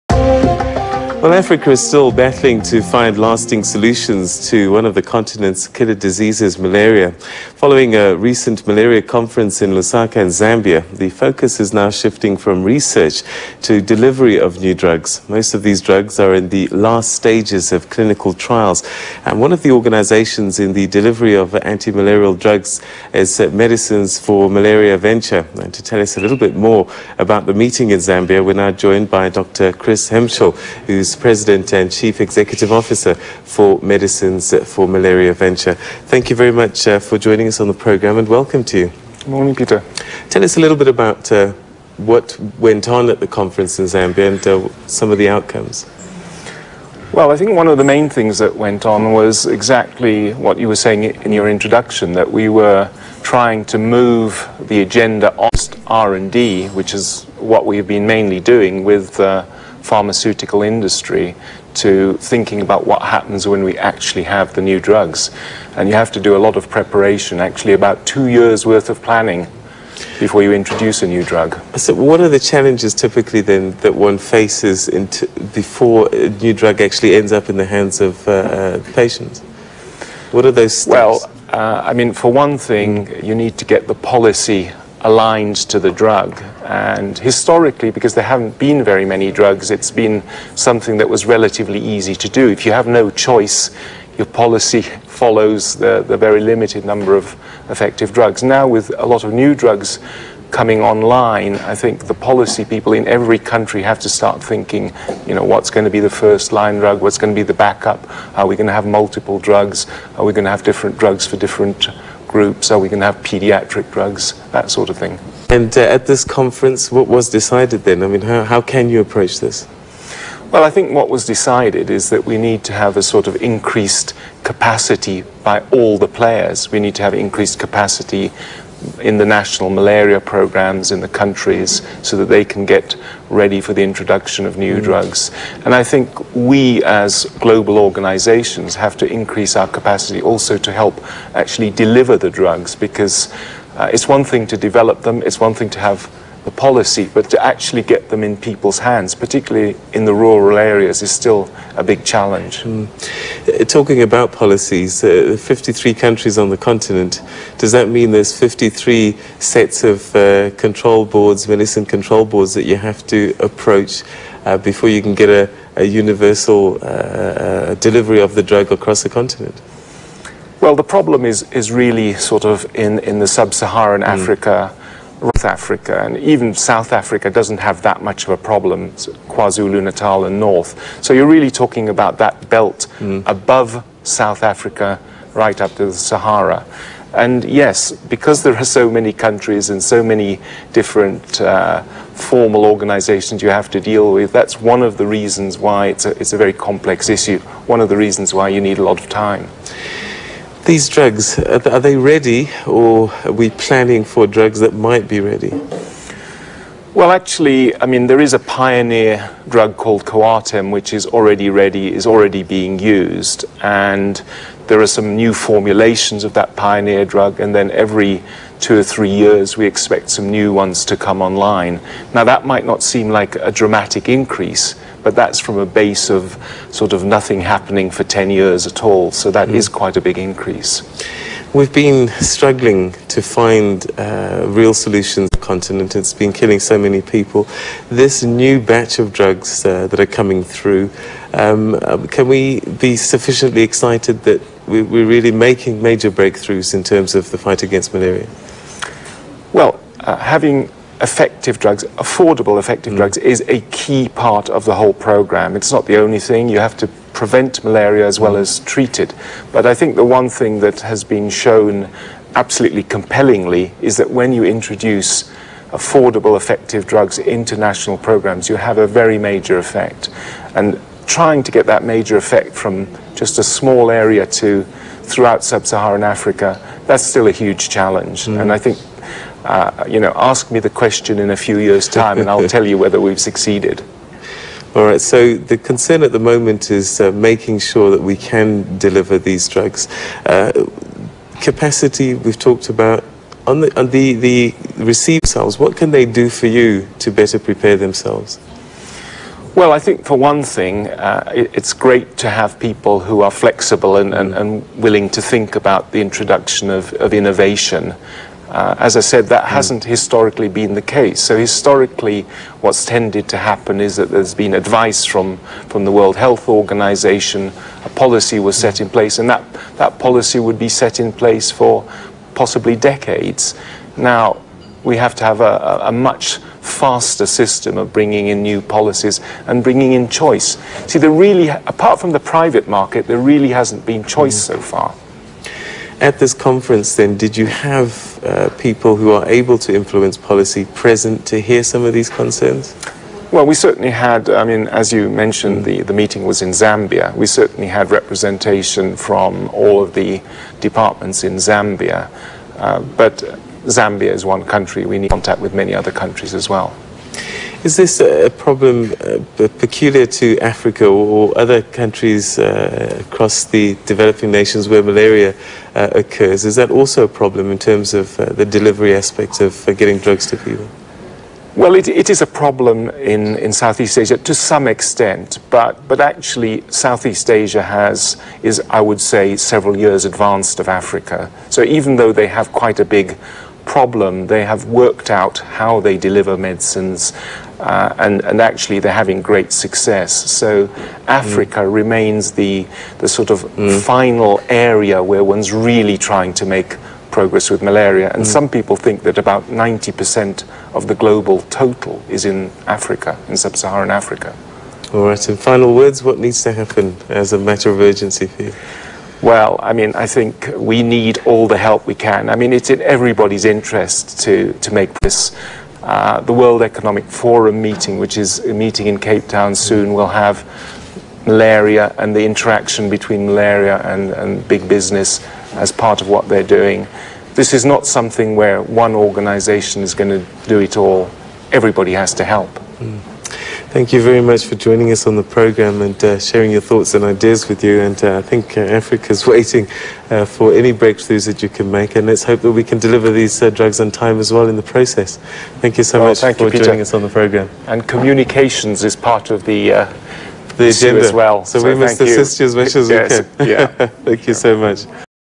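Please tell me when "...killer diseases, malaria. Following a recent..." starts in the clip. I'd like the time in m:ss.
0:05.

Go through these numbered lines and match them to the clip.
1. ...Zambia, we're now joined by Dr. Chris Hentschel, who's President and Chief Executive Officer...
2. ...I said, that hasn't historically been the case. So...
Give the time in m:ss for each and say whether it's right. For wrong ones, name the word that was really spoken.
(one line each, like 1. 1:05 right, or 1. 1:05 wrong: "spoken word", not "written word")
1. 0:27 right
2. 5:08 right.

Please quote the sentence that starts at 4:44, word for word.
All right, so the concern at the moment is uh, making sure that we can deliver these drugs.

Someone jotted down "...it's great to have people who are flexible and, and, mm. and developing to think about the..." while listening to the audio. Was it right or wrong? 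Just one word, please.
wrong.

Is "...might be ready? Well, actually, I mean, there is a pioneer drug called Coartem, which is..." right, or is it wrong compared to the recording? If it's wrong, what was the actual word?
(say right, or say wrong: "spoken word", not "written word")
right.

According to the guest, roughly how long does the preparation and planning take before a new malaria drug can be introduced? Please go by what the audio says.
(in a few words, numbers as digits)
2 years.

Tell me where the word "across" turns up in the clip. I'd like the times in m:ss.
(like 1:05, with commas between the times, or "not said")
2:48, 6:03.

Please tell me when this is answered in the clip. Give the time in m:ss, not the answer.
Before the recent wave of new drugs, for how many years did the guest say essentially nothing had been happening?
3:48.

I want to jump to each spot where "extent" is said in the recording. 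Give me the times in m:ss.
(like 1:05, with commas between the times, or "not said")
6:14.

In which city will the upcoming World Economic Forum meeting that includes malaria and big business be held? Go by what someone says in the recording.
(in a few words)
Cape Town.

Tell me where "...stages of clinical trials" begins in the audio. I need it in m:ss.
0:17.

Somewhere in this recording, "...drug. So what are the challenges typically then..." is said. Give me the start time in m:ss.
1:11.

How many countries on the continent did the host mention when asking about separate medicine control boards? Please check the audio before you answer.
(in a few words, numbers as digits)
53.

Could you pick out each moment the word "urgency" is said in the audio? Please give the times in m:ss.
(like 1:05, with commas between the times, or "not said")
6:47.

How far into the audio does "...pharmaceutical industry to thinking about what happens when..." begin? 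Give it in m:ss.
0:59.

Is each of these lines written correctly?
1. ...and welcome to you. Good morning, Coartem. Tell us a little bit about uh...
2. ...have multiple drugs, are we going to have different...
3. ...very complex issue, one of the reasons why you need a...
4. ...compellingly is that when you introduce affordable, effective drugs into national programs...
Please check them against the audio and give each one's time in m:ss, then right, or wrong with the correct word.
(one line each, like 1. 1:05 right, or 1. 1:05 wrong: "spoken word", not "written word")
1. 0:38 wrong: "Peter", not "Coartem"
2. 1:48 right
3. 3:16 right
4. 4:22 right.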